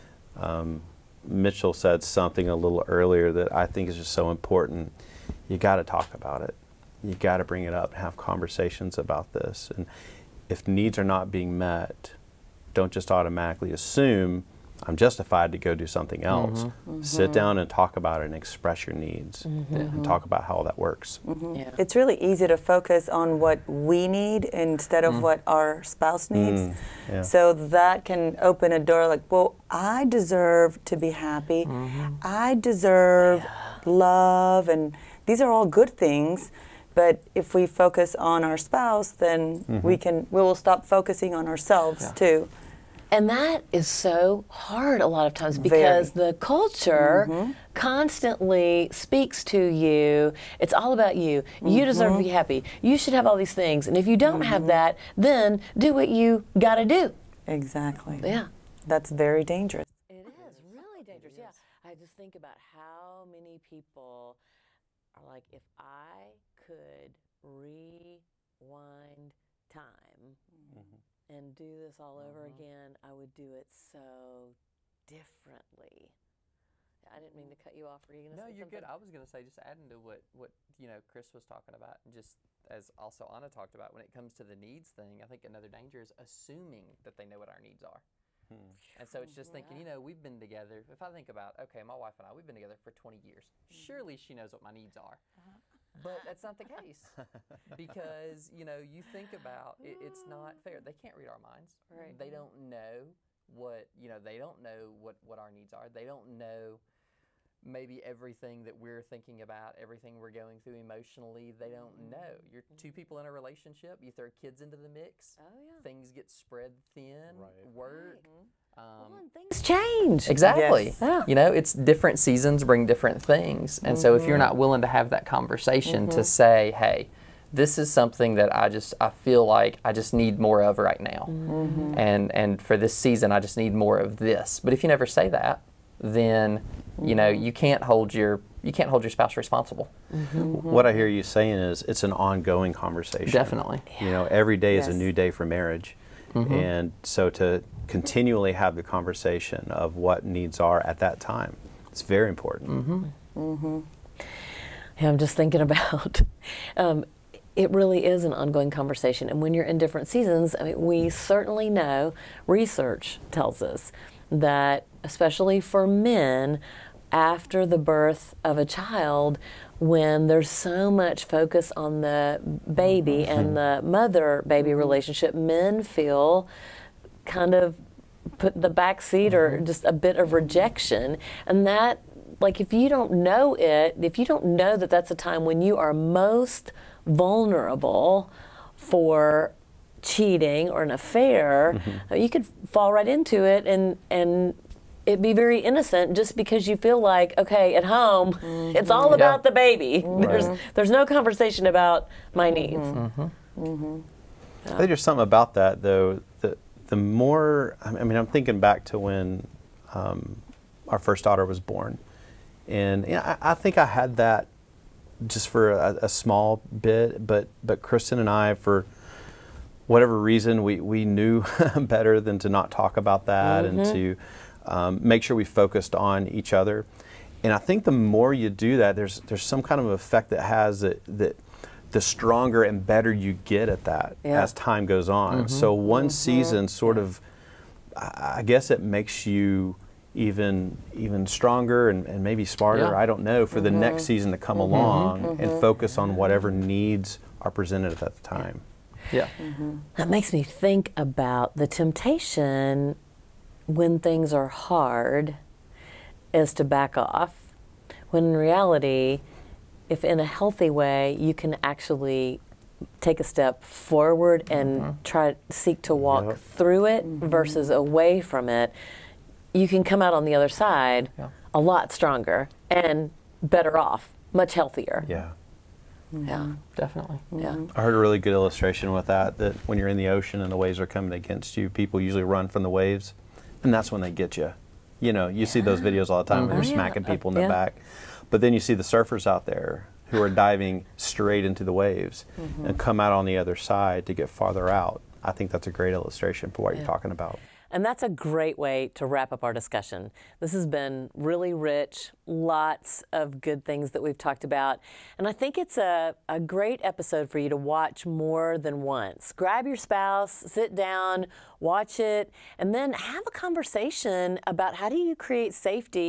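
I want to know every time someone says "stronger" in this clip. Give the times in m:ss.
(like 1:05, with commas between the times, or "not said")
3:52, 4:01, 4:31.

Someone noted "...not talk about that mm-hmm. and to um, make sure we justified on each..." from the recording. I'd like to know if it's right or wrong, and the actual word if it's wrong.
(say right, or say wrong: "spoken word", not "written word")
wrong: "focused", not "justified".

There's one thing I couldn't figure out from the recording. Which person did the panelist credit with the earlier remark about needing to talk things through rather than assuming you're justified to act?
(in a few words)
Mitchell.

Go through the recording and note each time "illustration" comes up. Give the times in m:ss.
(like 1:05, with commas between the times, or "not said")
4:38, 4:55.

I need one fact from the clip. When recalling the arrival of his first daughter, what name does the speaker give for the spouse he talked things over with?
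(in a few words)
Kristen.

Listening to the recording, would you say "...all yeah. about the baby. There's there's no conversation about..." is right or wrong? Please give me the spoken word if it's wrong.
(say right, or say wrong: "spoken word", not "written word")
right.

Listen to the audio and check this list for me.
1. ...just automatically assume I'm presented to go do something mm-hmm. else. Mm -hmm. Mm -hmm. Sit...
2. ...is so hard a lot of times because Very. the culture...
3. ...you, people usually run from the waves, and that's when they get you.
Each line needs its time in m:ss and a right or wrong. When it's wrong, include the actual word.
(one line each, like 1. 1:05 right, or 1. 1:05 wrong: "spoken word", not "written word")
1. 0:12 wrong: "justified", not "presented"
2. 0:43 right
3. 4:41 right.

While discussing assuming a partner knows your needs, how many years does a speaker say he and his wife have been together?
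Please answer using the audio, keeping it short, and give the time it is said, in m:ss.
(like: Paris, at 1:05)
20, at 1:32.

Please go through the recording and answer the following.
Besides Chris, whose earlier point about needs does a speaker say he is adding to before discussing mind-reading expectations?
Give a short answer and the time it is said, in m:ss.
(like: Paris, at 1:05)
Anna, at 1:23.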